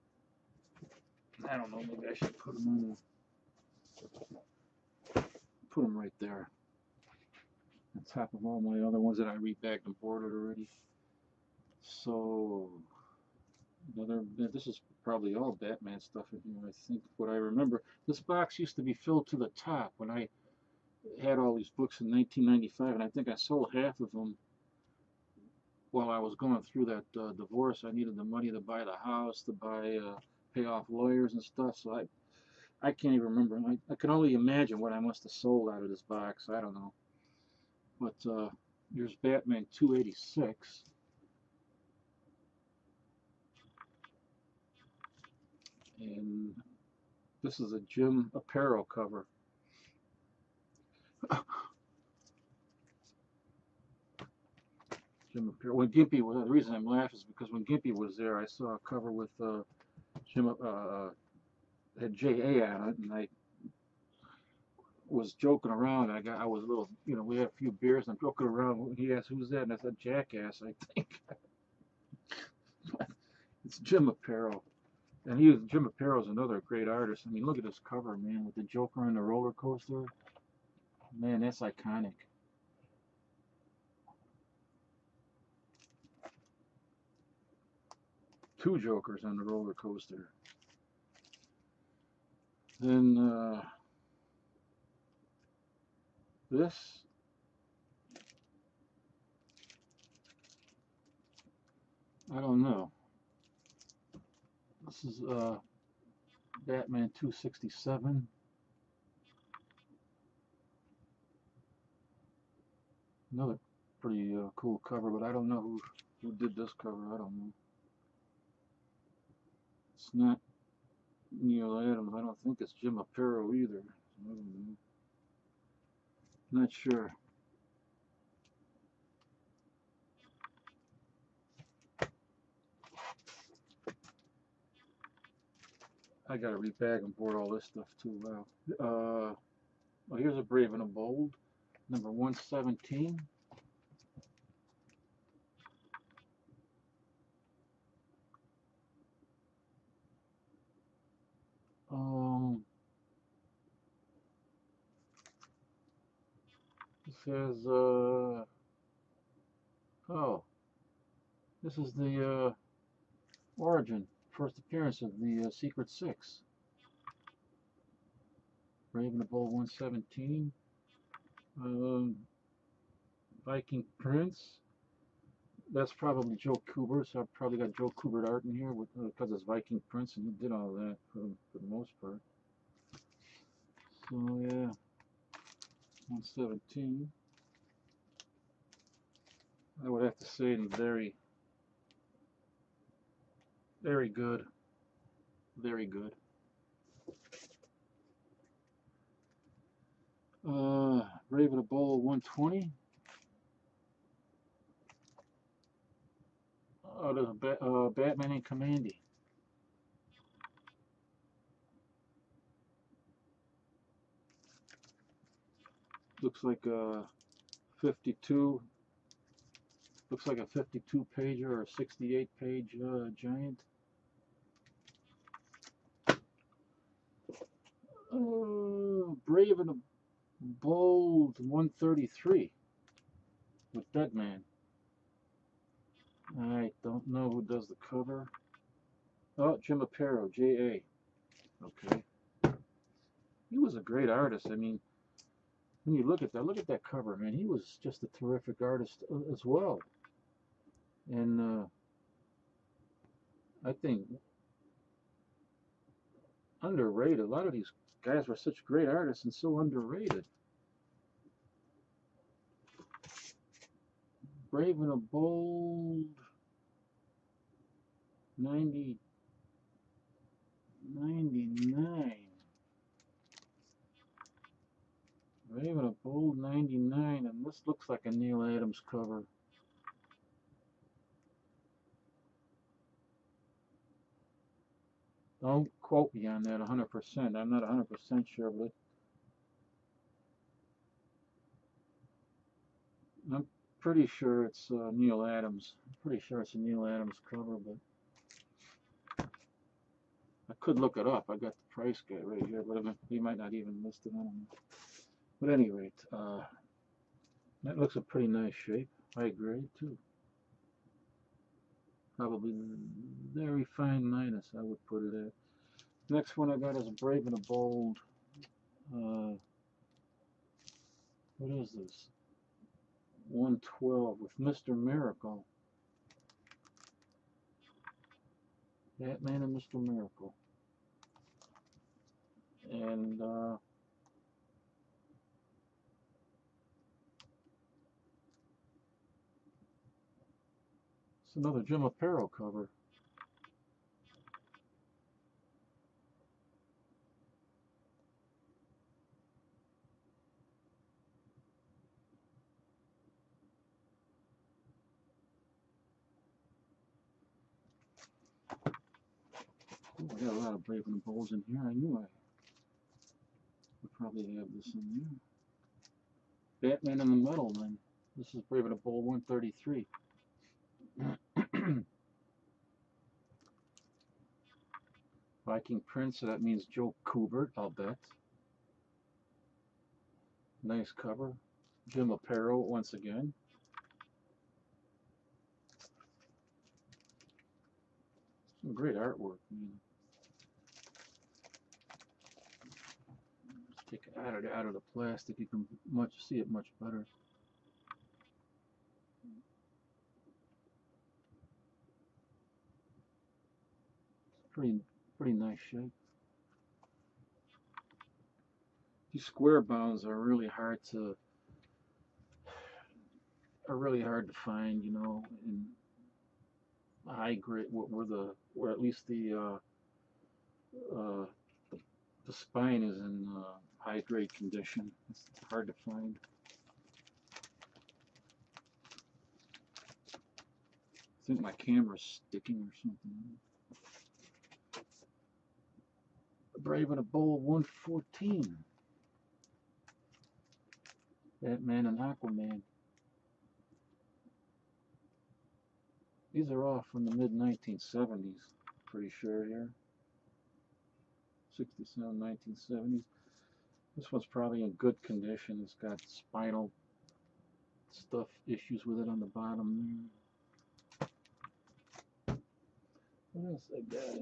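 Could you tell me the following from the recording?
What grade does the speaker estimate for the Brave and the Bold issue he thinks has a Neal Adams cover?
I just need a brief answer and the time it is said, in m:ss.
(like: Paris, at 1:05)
Very fine minus, at 5:13.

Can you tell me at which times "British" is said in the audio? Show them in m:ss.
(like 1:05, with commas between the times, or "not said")
not said.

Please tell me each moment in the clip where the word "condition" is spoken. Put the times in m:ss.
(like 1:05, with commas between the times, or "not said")
7:04, 7:35.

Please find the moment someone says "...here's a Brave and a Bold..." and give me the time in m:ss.
2:20.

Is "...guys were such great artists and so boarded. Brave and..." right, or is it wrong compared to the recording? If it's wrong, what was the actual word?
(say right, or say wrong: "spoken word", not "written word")
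wrong: "underrated", not "boarded".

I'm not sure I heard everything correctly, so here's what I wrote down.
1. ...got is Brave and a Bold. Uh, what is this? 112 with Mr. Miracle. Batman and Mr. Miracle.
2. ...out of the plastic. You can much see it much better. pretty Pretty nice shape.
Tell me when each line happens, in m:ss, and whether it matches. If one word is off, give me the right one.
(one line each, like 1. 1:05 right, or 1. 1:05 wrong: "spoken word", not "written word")
1. 5:16 right
2. 6:34 right.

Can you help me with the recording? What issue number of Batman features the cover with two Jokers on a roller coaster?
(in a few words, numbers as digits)
286.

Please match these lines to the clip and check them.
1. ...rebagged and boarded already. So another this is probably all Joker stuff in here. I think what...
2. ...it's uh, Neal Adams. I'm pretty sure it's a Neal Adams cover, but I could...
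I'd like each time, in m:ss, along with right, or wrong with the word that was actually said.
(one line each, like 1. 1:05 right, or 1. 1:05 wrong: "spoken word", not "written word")
1. 0:09 wrong: "Batman", not "Joker"
2. 4:54 right.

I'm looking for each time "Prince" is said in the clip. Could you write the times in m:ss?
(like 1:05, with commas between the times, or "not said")
2:53, 2:59, 6:15.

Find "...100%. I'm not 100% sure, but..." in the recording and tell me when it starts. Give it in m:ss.
4:46.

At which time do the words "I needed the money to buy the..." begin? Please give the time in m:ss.
0:27.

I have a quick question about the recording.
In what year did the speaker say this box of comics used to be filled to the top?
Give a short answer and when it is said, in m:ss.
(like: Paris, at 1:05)
1995, at 0:22.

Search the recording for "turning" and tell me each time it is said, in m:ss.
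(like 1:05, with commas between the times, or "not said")
not said.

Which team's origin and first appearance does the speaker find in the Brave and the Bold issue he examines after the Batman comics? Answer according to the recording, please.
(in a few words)
Secret Six.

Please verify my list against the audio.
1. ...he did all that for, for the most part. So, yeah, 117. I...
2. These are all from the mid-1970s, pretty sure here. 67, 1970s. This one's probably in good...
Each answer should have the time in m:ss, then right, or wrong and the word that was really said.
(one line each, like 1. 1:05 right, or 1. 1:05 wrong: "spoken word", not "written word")
1. 3:00 right
2. 7:26 right.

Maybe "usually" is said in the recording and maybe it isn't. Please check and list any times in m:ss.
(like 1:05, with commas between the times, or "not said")
not said.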